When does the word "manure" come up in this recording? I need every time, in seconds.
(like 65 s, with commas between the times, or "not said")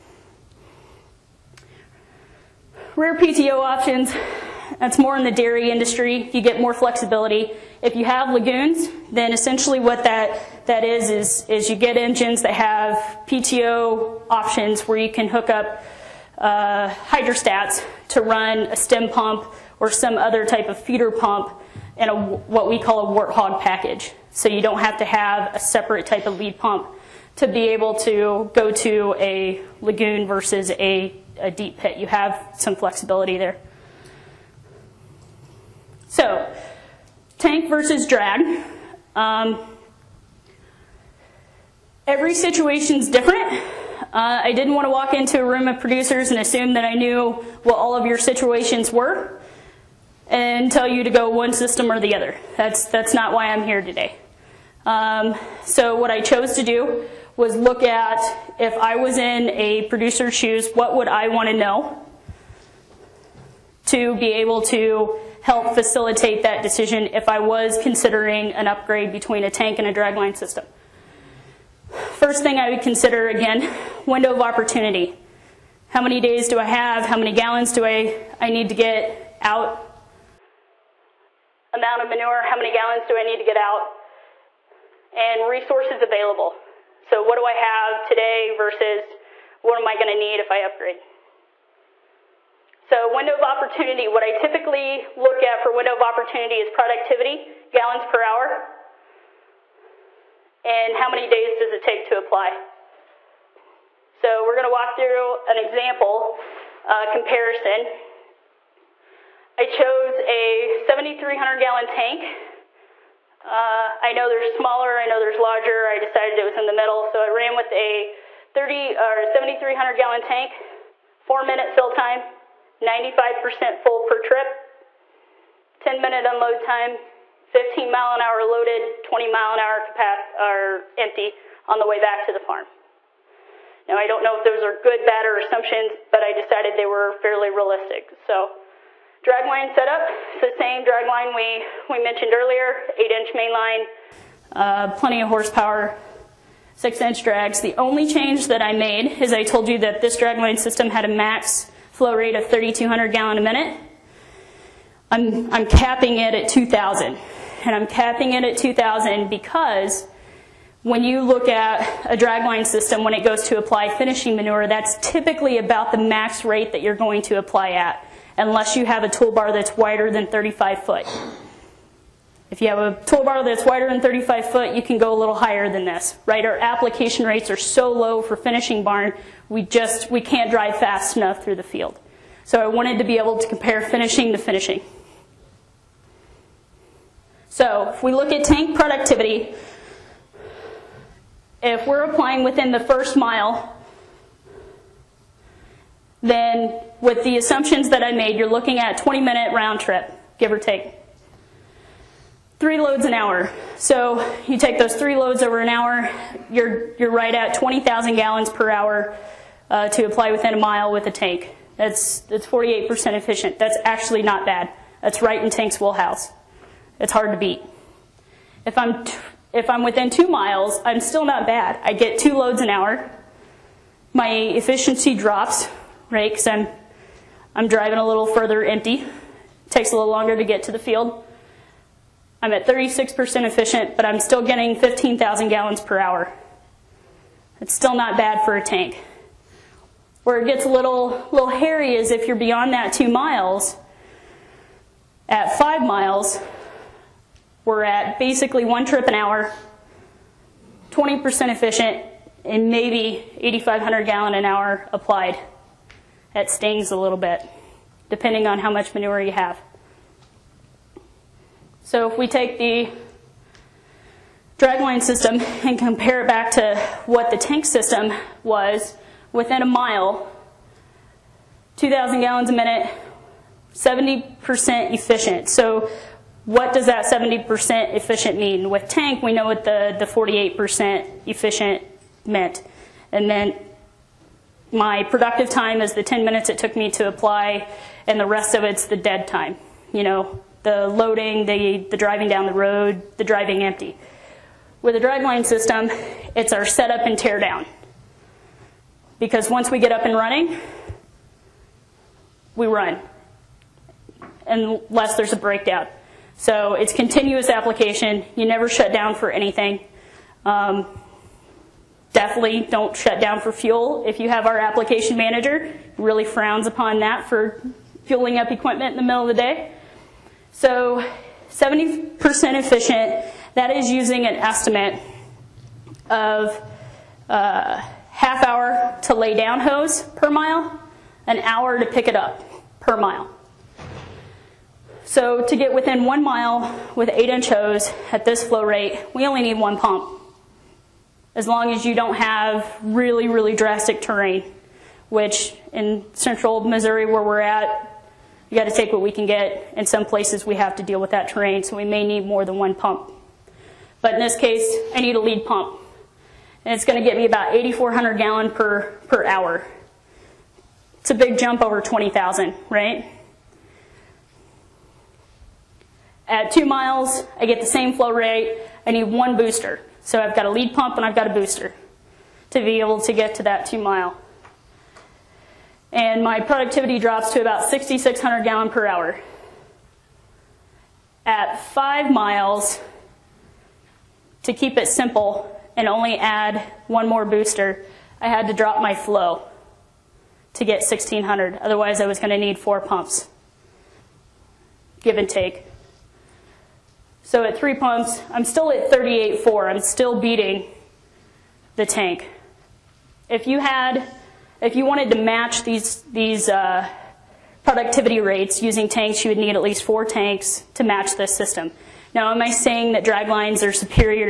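82 s, 164 s, 258 s.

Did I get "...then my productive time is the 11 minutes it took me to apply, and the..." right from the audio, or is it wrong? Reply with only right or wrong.
wrong.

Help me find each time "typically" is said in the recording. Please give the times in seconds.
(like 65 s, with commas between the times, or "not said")
94 s, 165 s.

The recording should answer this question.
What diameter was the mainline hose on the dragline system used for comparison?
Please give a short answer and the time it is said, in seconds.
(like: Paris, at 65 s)
8 inch, at 142 s.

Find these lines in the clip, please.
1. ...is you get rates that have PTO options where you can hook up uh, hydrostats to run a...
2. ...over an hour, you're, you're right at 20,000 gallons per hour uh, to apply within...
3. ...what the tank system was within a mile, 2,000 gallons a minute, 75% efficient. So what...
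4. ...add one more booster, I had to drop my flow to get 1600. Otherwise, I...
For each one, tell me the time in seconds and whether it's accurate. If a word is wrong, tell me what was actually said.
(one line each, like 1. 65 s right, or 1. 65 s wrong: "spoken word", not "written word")
1. 11 s wrong: "engines", not "rates"
2. 205 s right
3. 267 s wrong: "70", not "75"
4. 386 s right.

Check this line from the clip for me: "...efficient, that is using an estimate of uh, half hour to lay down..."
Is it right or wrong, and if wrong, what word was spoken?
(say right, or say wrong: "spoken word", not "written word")
right.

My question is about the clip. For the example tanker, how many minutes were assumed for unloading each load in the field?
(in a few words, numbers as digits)
10 minutes.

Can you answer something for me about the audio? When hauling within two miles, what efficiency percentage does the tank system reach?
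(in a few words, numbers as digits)
36%.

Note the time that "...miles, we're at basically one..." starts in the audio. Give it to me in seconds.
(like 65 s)
245 s.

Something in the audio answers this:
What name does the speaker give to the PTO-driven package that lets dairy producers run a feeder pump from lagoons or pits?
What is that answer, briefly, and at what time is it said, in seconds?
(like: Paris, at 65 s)
warthog package, at 23 s.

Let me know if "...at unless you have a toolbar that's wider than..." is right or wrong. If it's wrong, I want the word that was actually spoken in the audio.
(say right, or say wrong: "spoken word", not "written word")
right.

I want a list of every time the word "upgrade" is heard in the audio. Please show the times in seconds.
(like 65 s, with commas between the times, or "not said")
68 s, 90 s.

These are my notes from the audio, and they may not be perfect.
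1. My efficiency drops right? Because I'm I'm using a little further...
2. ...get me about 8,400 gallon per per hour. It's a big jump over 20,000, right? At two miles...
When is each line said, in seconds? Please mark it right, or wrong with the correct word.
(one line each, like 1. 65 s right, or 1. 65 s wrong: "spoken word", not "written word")
1. 224 s wrong: "driving", not "using"
2. 357 s right.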